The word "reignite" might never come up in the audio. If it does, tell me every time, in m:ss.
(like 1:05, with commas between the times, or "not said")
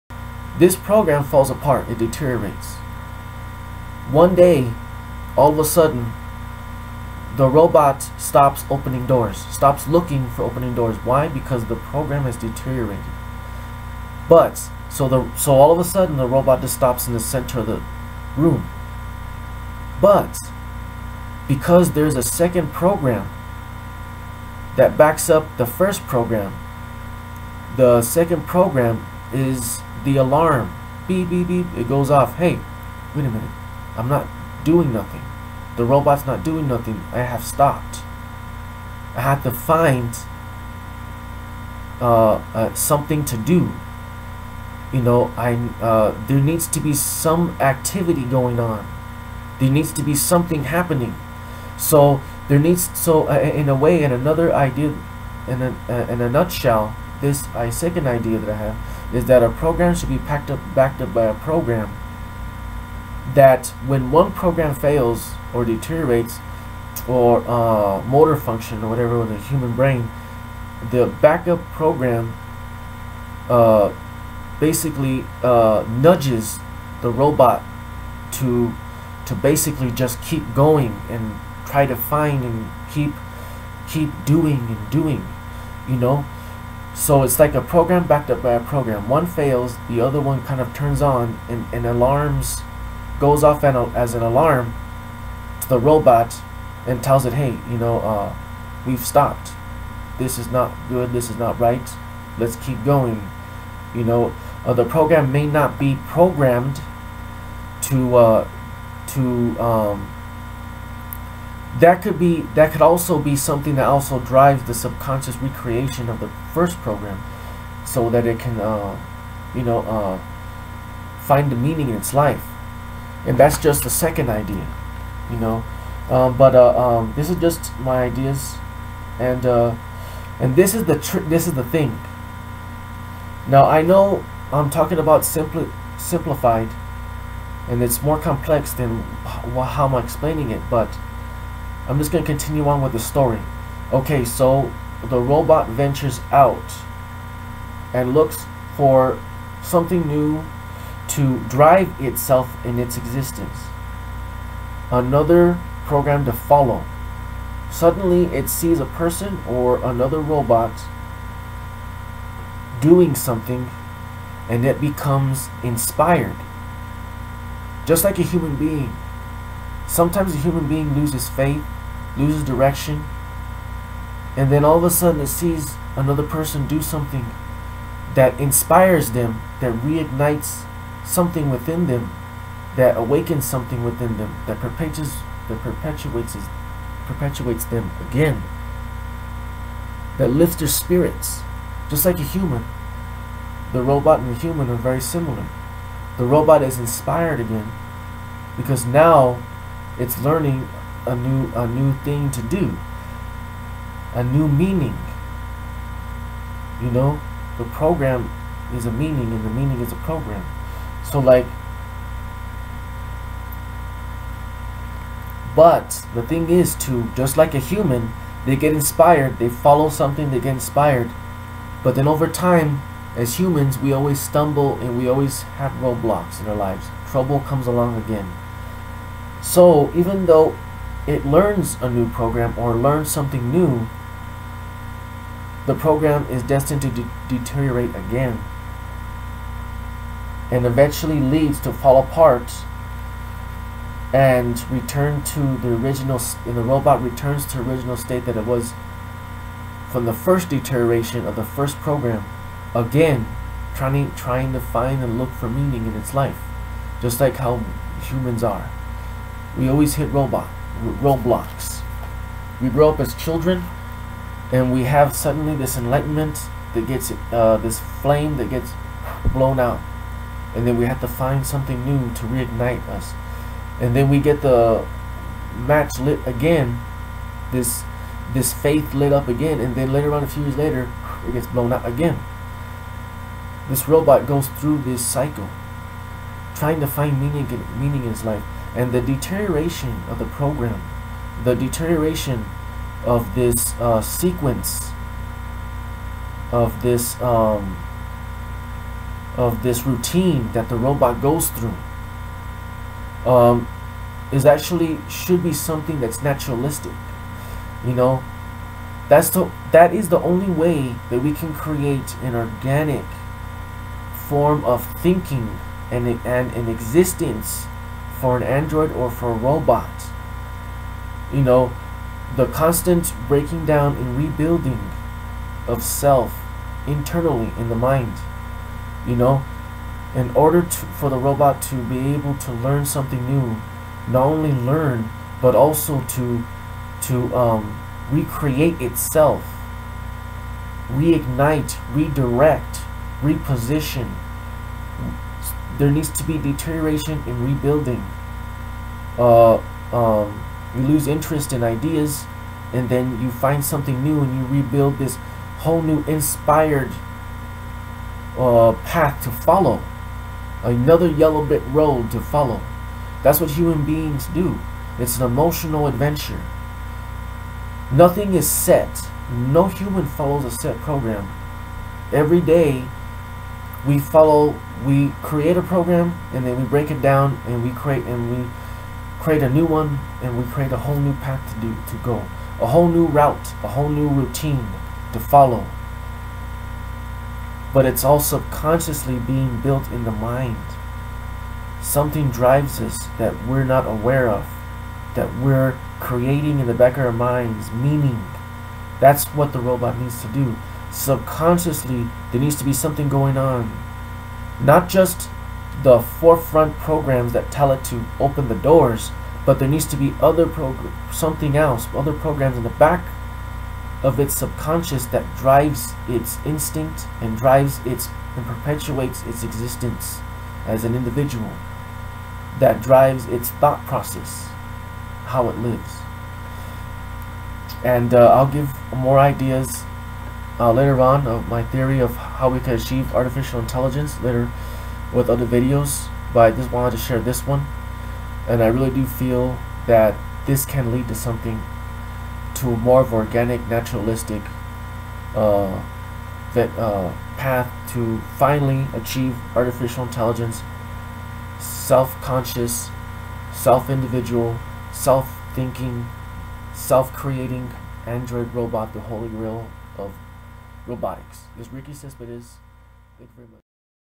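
2:59, 4:32, 5:40.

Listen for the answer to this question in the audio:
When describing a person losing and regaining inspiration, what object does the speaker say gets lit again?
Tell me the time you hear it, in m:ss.
4:35.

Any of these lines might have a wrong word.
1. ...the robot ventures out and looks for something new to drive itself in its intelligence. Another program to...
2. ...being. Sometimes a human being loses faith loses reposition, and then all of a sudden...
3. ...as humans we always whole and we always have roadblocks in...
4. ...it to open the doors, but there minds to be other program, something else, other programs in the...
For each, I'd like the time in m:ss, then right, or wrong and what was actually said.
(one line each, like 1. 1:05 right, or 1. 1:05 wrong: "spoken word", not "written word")
1. 2:25 wrong: "existence", not "intelligence"
2. 2:48 wrong: "direction", not "reposition"
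3. 3:43 wrong: "stumble", not "whole"
4. 6:47 wrong: "needs", not "minds".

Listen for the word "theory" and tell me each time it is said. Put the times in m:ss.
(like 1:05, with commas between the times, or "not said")
7:11.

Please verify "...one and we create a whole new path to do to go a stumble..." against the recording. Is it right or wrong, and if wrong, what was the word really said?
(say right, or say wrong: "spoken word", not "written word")
wrong: "whole", not "stumble".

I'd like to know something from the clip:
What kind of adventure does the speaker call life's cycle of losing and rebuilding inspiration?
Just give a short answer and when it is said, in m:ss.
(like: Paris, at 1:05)
An emotional adventure, at 6:05.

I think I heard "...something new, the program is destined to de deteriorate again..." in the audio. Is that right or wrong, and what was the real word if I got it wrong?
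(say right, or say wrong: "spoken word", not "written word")
right.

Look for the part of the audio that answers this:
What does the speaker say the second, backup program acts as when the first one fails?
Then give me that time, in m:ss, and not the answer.
0:30.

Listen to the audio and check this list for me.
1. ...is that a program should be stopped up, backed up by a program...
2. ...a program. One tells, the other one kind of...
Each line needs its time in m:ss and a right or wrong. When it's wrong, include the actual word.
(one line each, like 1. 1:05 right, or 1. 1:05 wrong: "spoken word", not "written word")
1. 0:59 wrong: "packed", not "stopped"
2. 1:28 wrong: "fails", not "tells".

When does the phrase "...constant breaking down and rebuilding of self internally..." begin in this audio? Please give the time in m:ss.
5:22.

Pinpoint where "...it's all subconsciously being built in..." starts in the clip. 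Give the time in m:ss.
6:27.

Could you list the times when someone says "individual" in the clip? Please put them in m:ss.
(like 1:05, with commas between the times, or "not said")
7:00, 7:33.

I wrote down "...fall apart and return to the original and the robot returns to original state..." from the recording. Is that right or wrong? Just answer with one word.
right.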